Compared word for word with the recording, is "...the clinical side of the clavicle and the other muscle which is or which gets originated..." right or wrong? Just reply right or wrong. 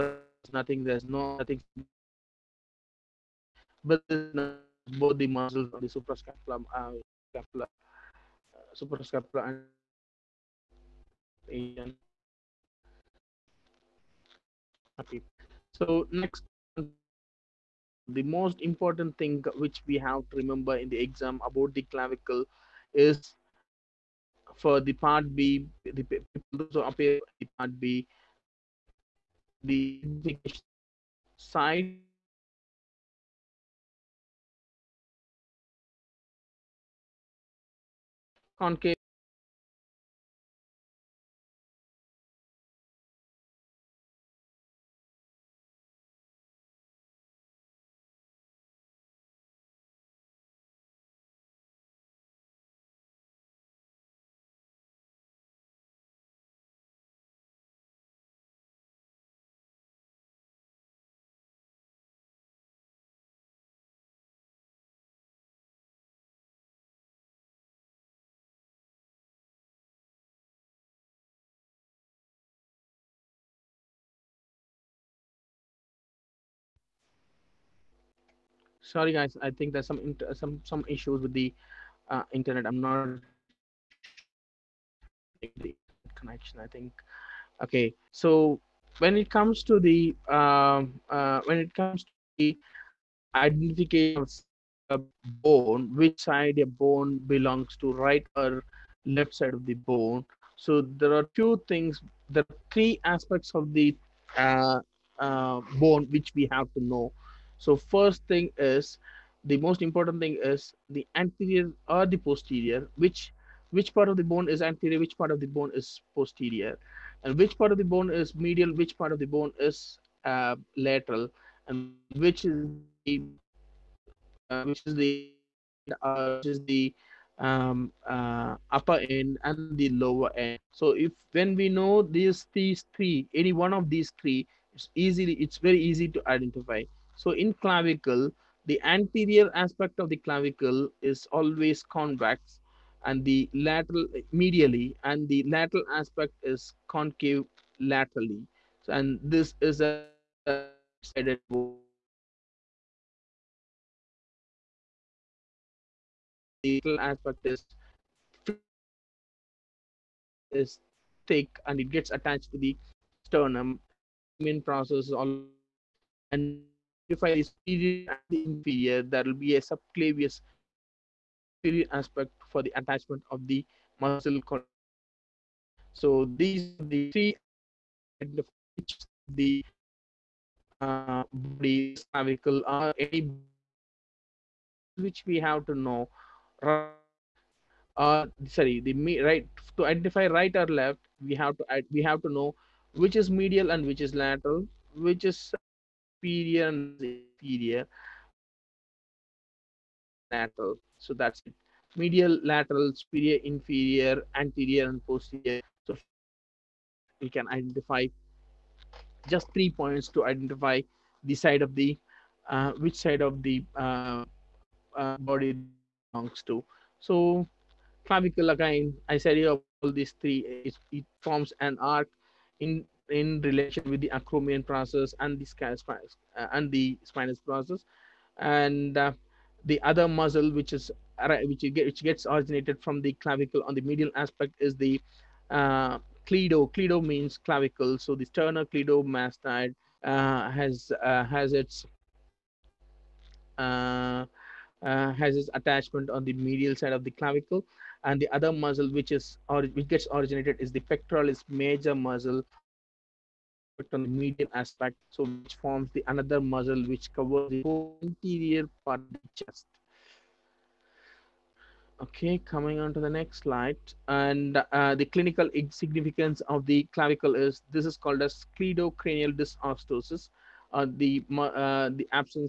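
wrong.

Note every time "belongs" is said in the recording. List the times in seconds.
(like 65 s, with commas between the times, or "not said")
97 s, 216 s.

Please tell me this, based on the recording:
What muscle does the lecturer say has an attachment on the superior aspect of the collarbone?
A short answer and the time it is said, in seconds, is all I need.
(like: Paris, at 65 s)
Subclavius, at 169 s.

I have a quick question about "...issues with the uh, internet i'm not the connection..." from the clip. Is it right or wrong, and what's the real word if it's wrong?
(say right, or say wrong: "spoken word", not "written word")
right.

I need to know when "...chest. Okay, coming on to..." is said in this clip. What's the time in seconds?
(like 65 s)
259 s.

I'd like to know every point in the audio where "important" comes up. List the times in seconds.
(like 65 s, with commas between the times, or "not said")
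18 s, 109 s.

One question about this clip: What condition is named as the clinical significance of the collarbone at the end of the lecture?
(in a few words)
Cleidocranial dysostosis.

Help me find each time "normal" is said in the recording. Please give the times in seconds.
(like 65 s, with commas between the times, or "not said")
not said.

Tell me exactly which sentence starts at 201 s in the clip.
Medial, lateral, superior, inferior, anterior, and posterior.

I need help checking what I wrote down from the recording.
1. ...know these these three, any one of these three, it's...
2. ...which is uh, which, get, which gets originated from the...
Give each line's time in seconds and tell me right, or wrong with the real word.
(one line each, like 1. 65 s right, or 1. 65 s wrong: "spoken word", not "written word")
1. 131 s right
2. 230 s right.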